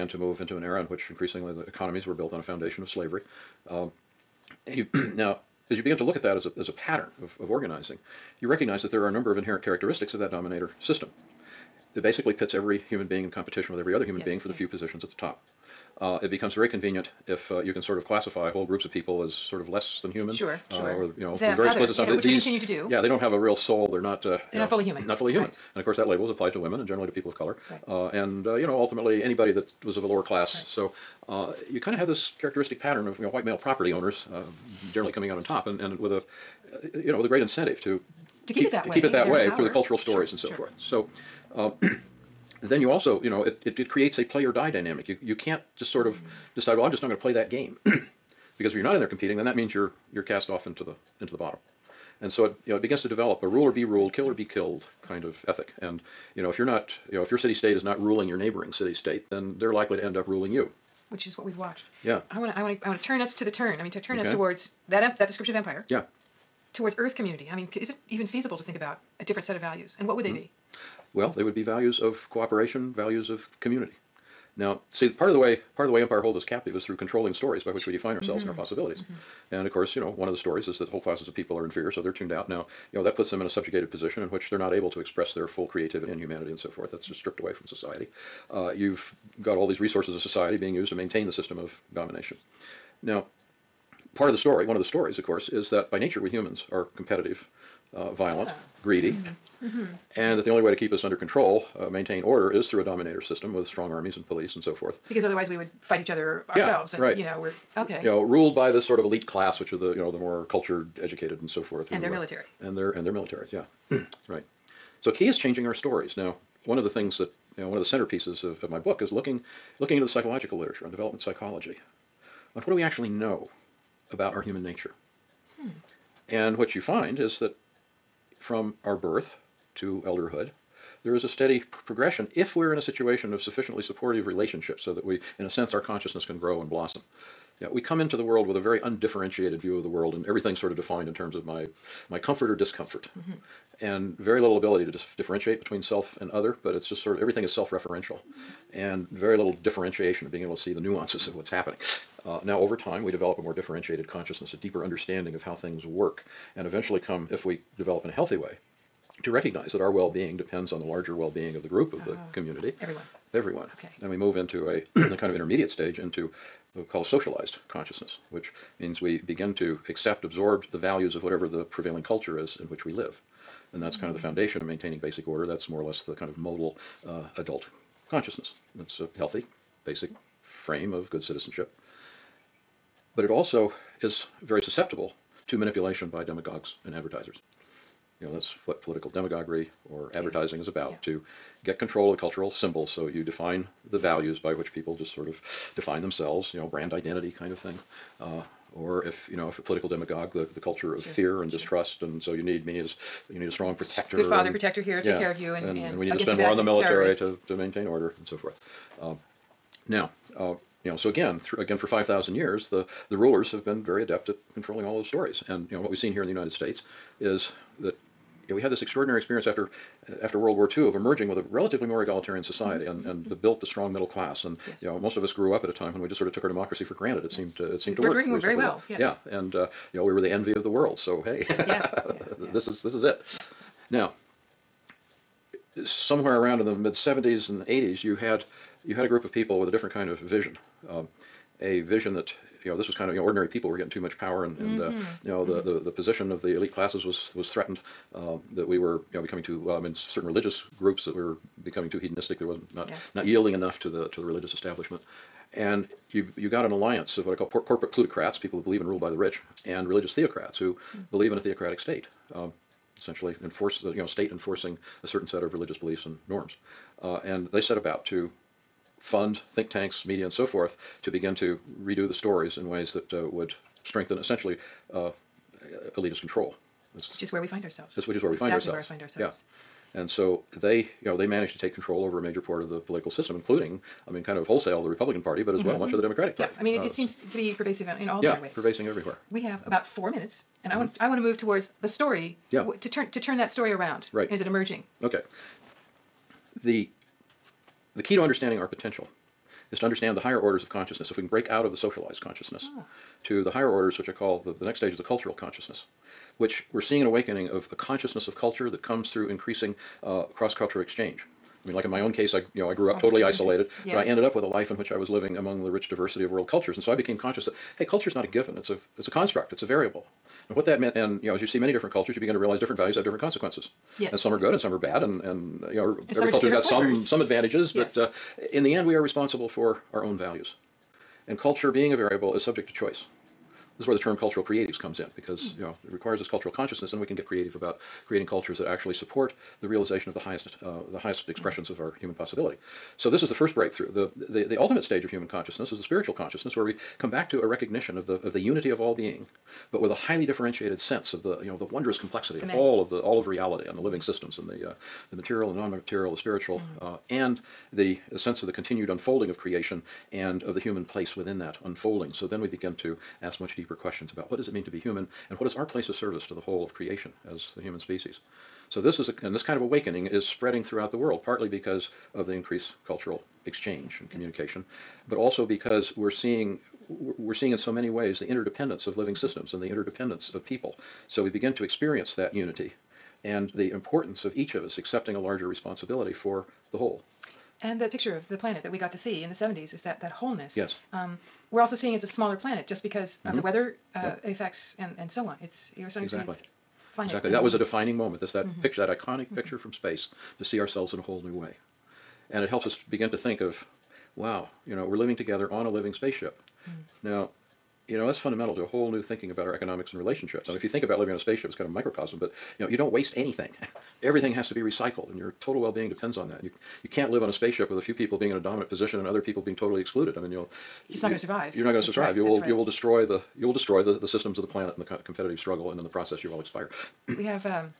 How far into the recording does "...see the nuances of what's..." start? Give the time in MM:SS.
02:30.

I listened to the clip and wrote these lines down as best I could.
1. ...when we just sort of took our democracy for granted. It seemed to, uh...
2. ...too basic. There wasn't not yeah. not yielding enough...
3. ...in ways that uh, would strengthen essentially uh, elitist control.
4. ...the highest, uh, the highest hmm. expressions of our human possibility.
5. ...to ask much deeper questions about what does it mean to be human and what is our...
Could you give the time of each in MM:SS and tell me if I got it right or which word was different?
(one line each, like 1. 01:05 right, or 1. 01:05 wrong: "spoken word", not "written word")
1. 03:45 right
2. 04:11 wrong: "hedonistic", not "basic"
3. 04:32 right
4. 05:40 right
5. 06:02 right.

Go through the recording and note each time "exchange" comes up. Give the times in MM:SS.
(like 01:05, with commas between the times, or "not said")
05:10, 06:13.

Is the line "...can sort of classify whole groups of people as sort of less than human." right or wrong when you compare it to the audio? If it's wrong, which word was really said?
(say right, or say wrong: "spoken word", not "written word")
right.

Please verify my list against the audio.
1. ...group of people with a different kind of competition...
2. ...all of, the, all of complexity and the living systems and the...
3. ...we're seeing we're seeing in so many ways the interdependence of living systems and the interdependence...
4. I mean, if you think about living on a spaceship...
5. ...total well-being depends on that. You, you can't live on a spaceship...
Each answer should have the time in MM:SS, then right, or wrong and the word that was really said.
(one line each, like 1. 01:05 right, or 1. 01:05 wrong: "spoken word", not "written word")
1. 03:59 wrong: "vision", not "competition"
2. 05:52 wrong: "reality", not "complexity"
3. 06:15 right
4. 06:50 right
5. 06:55 right.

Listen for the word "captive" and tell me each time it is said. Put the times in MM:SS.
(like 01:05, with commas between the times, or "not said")
01:16.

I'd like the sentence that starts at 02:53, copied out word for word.
And that's kind of the foundation of maintaining basic order.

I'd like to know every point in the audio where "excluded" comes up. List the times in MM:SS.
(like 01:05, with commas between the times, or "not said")
06:59.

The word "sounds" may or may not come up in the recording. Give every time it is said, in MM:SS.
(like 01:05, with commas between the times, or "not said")
not said.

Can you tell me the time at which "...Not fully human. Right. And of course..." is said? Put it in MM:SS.
00:25.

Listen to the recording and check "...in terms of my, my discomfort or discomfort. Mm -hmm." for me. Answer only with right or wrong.
wrong.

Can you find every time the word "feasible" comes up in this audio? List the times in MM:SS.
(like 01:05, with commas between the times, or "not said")
01:08.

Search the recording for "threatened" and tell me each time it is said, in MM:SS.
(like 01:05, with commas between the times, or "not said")
04:07.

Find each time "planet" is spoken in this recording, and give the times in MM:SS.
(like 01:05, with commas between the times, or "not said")
06:28, 06:32, 07:04.